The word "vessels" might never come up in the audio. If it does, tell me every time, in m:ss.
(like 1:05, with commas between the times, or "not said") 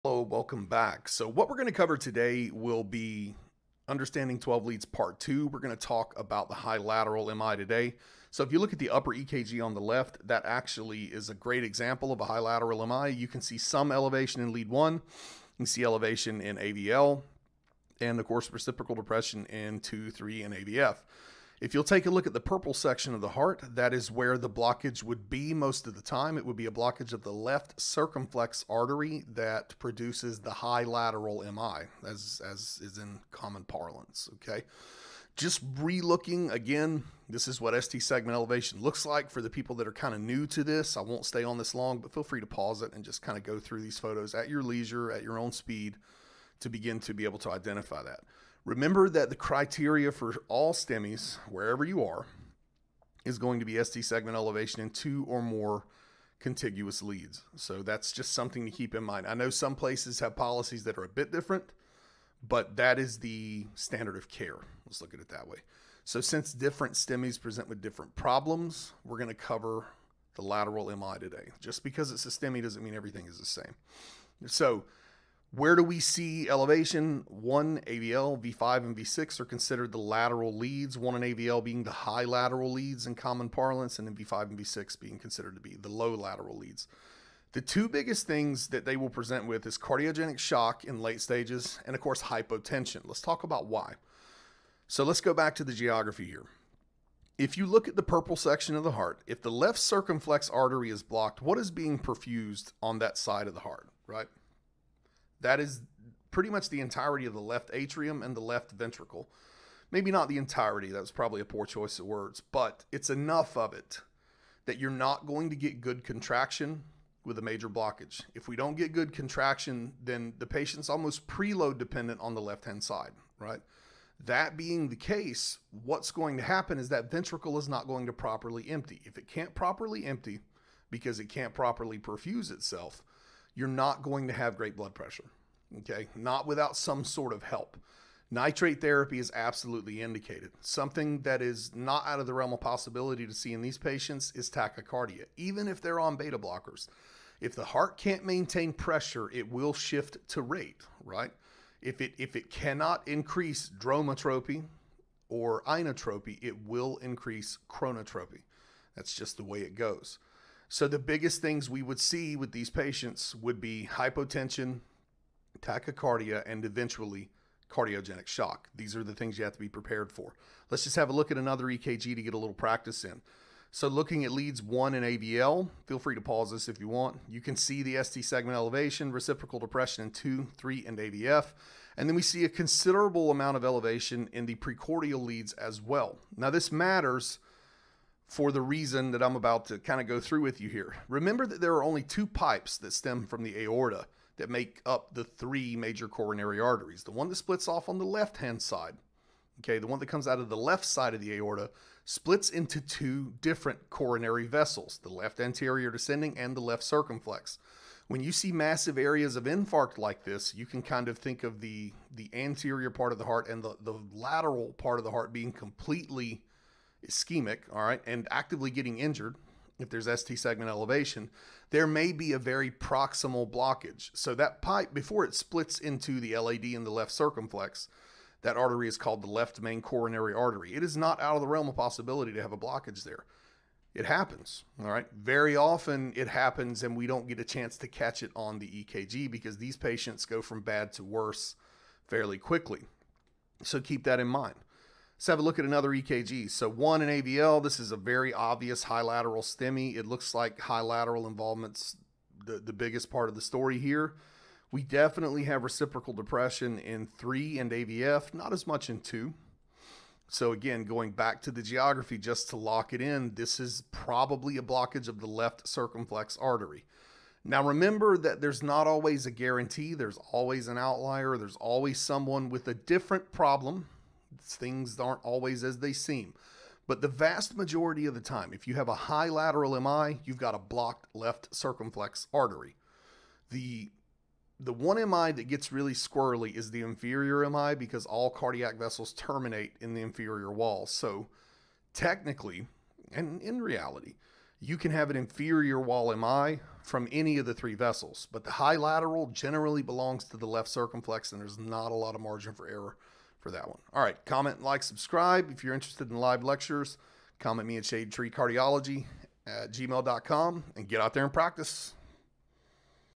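3:24, 4:48, 4:57.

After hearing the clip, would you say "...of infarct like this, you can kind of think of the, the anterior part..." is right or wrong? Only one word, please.
right.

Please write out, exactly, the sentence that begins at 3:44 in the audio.
So that pipe, before it splits into the LAD and the left circumflex, that artery is called the left main coronary artery.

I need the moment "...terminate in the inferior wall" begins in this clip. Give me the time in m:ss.
4:49.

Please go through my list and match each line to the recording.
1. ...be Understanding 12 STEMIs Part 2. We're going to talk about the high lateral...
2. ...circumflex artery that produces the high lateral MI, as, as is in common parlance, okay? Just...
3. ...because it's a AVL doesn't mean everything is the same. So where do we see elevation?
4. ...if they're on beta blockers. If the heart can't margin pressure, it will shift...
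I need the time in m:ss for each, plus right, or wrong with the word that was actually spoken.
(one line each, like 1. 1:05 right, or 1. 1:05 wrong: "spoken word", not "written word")
1. 0:02 wrong: "Leads", not "STEMIs"
2. 0:27 right
3. 1:11 wrong: "STEMI", not "AVL"
4. 2:25 wrong: "maintain", not "margin".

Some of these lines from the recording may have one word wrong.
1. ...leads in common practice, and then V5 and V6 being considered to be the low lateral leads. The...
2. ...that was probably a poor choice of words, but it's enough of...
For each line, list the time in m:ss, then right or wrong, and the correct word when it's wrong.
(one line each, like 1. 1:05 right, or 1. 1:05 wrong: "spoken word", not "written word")
1. 1:22 wrong: "parlance", not "practice"
2. 1:50 right.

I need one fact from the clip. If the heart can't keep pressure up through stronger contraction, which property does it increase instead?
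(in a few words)
Chronotropy.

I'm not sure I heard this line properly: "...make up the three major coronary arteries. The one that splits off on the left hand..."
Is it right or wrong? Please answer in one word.
right.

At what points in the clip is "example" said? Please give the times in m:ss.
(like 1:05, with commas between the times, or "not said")
0:11.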